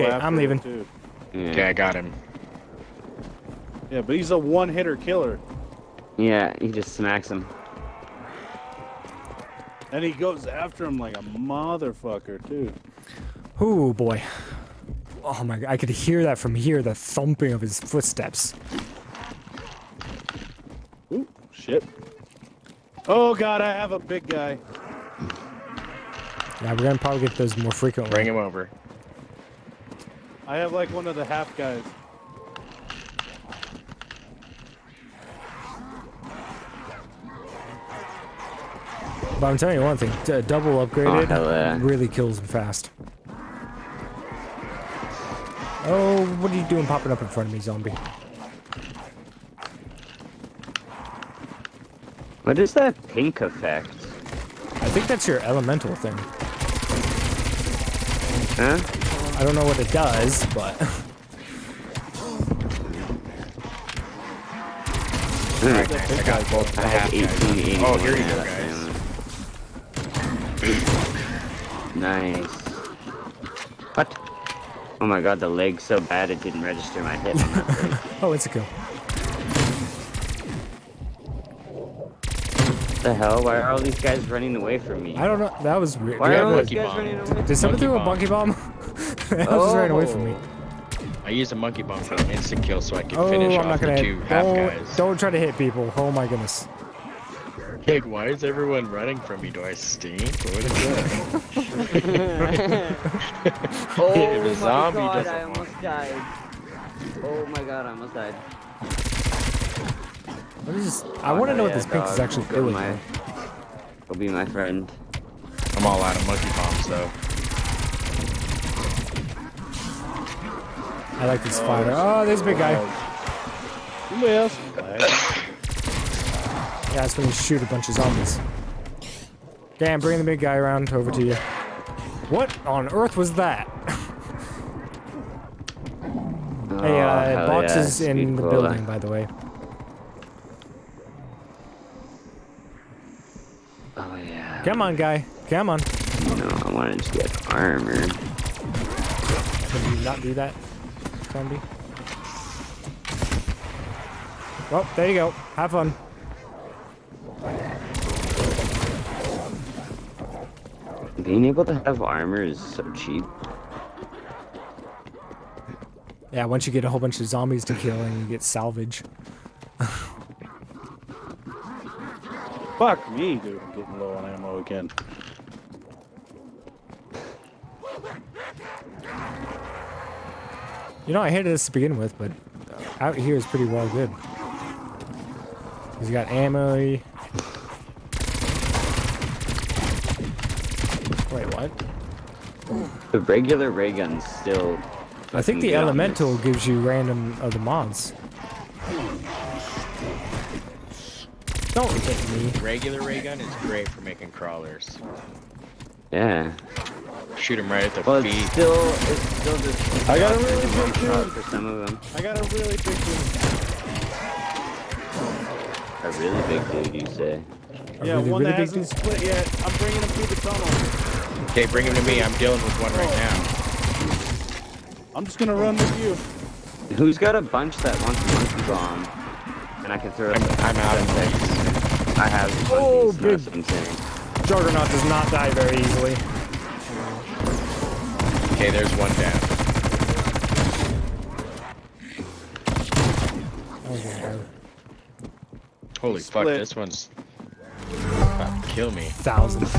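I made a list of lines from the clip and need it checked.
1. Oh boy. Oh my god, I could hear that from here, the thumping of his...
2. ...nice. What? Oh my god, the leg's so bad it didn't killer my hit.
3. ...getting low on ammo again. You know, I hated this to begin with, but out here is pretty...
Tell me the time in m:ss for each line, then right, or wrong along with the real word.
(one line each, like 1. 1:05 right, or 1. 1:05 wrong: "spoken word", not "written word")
1. 0:13 right
2. 1:11 wrong: "register", not "killer"
3. 2:53 right.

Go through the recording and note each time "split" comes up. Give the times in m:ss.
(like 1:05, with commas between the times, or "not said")
3:38, 4:06.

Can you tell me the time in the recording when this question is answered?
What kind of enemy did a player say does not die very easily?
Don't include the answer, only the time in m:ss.
3:54.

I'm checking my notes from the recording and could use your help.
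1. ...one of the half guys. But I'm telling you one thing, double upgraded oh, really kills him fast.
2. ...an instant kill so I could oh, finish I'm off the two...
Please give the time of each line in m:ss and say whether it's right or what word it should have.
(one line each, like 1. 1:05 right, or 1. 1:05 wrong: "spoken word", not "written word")
1. 0:30 right
2. 1:32 right.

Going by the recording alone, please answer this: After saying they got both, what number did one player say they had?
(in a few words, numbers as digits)
18.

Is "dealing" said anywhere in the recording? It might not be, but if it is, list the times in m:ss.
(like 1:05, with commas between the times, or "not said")
3:42.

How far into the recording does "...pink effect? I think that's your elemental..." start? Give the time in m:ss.
0:53.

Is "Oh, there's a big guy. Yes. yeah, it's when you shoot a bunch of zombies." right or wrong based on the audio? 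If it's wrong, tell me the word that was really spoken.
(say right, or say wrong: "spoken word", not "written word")
right.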